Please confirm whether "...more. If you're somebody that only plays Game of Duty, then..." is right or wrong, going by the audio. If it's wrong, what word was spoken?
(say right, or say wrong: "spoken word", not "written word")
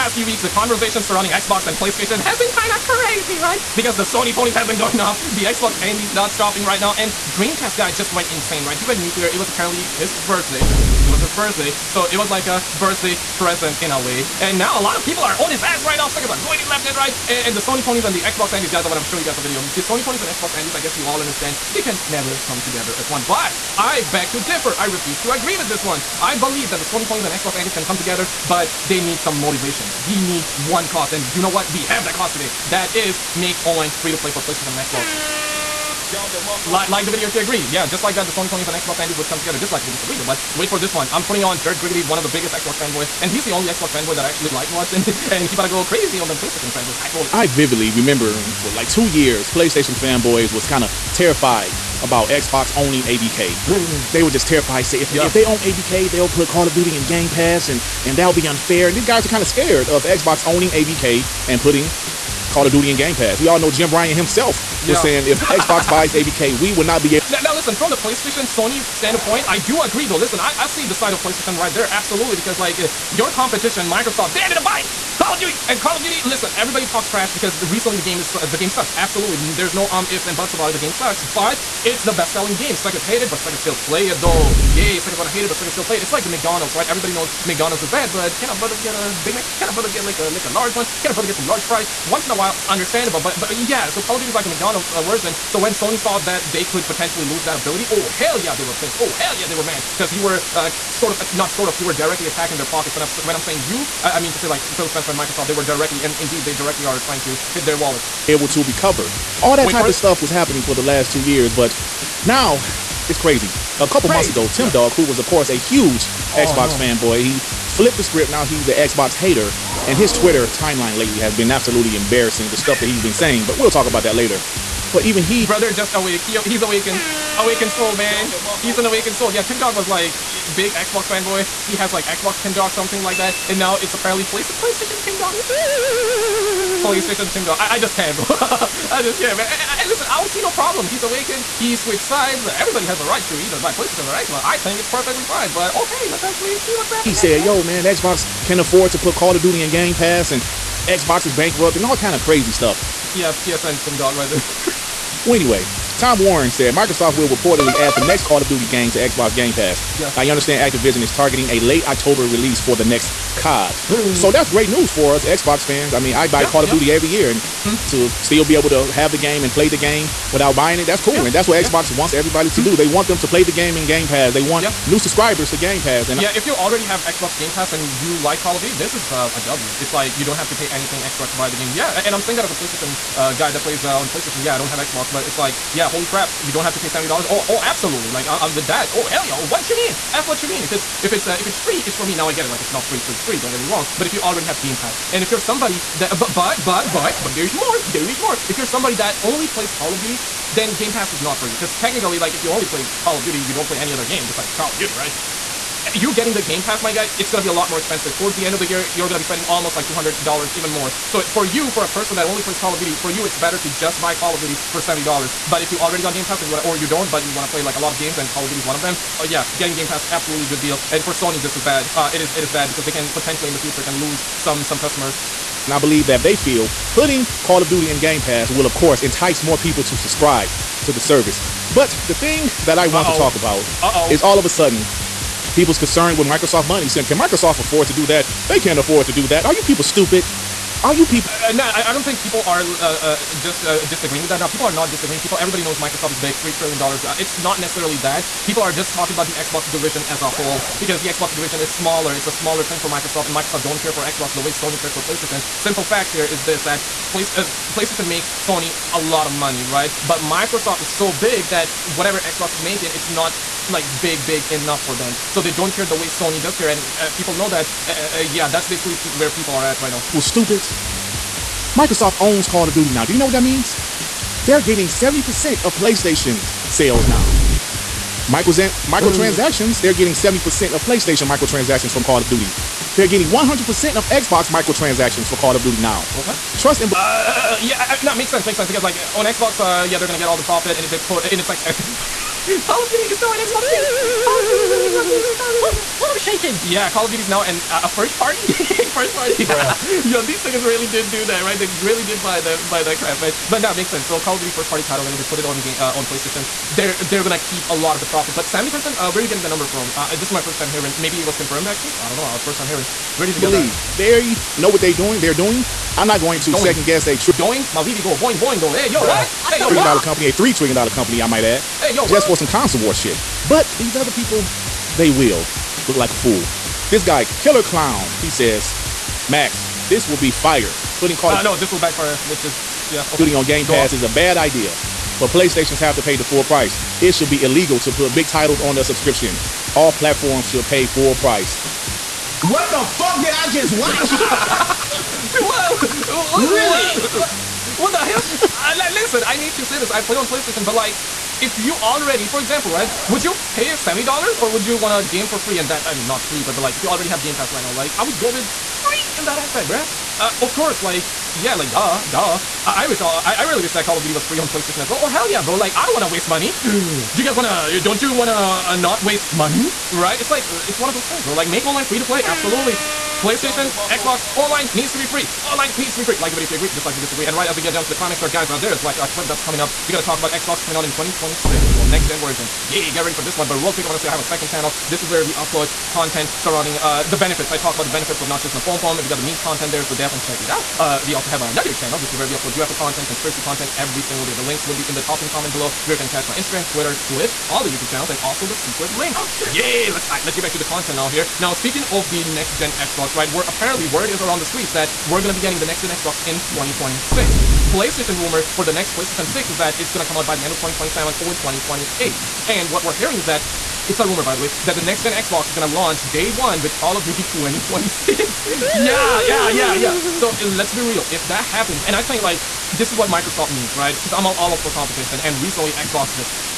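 wrong: "Call", not "Game".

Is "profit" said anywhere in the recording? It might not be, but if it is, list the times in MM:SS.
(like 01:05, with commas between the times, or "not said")
04:50, 05:08.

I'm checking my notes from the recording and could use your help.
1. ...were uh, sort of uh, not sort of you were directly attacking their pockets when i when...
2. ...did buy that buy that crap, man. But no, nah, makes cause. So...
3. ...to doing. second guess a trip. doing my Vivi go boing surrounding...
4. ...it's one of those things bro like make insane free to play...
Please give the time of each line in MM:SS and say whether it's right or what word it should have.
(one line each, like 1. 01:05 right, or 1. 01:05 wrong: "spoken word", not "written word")
1. 01:40 right
2. 05:02 wrong: "sense", not "cause"
3. 05:16 wrong: "boing", not "surrounding"
4. 06:10 wrong: "online", not "insane".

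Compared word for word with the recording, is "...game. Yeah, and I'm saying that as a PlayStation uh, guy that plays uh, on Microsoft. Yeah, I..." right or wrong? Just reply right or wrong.
wrong.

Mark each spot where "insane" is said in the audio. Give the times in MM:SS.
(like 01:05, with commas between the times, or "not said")
00:08.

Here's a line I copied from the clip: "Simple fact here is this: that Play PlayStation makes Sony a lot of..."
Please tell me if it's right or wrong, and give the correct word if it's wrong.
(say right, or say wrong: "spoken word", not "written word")
right.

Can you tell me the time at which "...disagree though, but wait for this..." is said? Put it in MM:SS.
00:39.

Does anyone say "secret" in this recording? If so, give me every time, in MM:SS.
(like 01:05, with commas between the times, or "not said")
06:38.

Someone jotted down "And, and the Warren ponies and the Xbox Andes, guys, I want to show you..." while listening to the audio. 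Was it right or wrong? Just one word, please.
wrong.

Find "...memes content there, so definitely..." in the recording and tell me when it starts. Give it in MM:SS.
06:29.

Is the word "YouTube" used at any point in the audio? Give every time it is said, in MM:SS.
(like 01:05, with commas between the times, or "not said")
06:37.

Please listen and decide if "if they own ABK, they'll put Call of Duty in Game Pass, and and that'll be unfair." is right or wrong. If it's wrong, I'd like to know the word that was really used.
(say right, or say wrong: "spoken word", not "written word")
right.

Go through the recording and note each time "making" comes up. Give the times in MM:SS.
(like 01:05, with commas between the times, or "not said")
04:22, 04:56.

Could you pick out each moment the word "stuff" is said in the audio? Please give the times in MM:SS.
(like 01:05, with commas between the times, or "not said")
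01:49, 02:02, 02:32.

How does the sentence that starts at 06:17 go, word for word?
And right as we get down to the climax there, guys, uh, there is like a clip that's coming up.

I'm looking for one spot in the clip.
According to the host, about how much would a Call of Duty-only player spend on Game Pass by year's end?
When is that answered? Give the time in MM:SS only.
03:29.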